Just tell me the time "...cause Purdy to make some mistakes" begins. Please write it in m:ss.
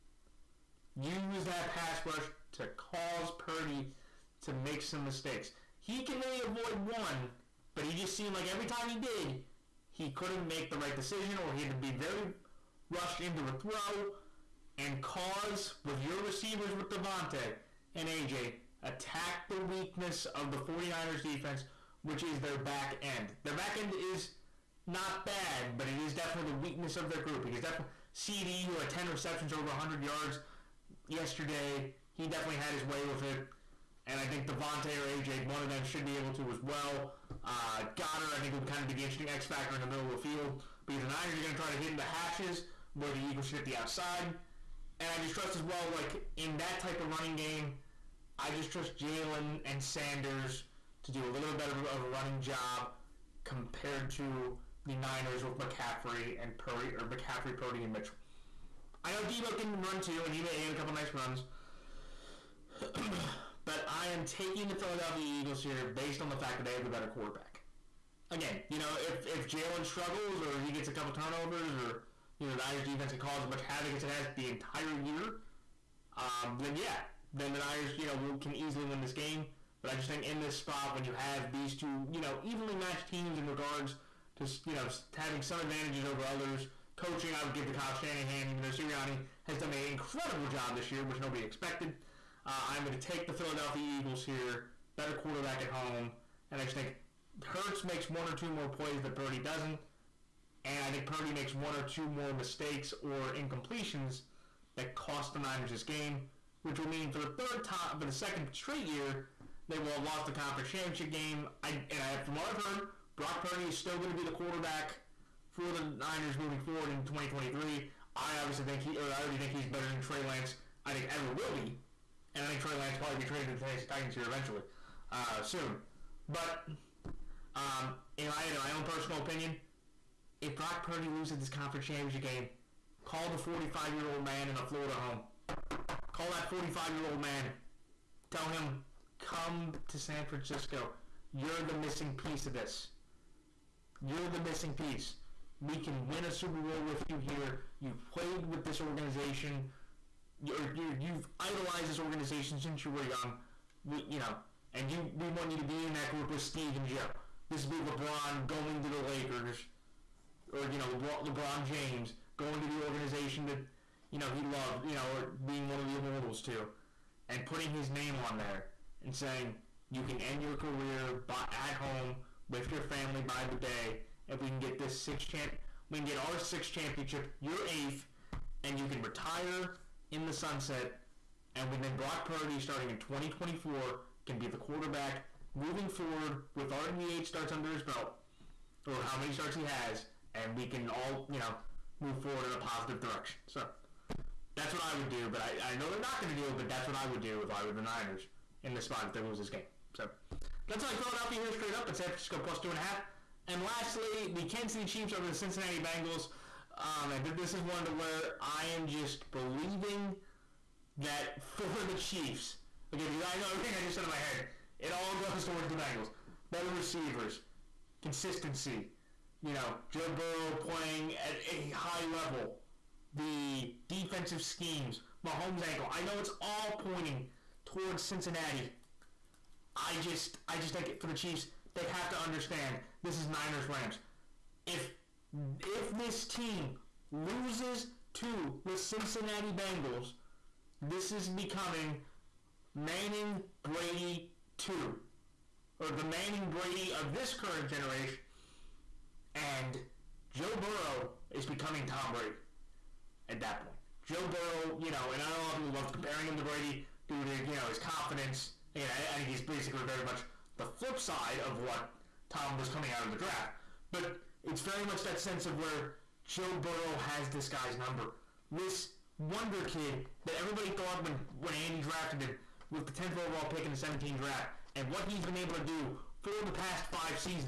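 0:02.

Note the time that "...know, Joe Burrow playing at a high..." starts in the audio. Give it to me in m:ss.
3:39.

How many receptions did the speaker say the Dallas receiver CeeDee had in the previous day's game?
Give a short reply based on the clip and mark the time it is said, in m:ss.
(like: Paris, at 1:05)
10, at 0:28.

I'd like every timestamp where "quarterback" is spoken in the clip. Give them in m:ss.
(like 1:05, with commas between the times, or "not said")
1:07, 1:35, 1:54, 3:04.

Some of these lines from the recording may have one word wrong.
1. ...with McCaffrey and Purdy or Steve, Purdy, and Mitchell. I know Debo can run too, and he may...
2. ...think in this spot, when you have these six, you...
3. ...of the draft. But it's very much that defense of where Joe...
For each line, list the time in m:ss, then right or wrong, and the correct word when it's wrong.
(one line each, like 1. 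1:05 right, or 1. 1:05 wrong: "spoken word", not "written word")
1. 0:55 wrong: "McCaffrey", not "Steve"
2. 1:20 wrong: "two", not "six"
3. 4:23 wrong: "sense", not "defense".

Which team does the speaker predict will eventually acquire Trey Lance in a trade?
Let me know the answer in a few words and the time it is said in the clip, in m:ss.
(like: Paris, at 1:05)
Tennessee Titans, at 2:03.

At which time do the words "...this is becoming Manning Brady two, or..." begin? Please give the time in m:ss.
4:00.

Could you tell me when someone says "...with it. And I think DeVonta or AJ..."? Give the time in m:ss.
0:33.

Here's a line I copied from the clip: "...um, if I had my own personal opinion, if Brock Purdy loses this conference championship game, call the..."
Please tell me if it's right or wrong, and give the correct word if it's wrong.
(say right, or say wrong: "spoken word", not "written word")
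right.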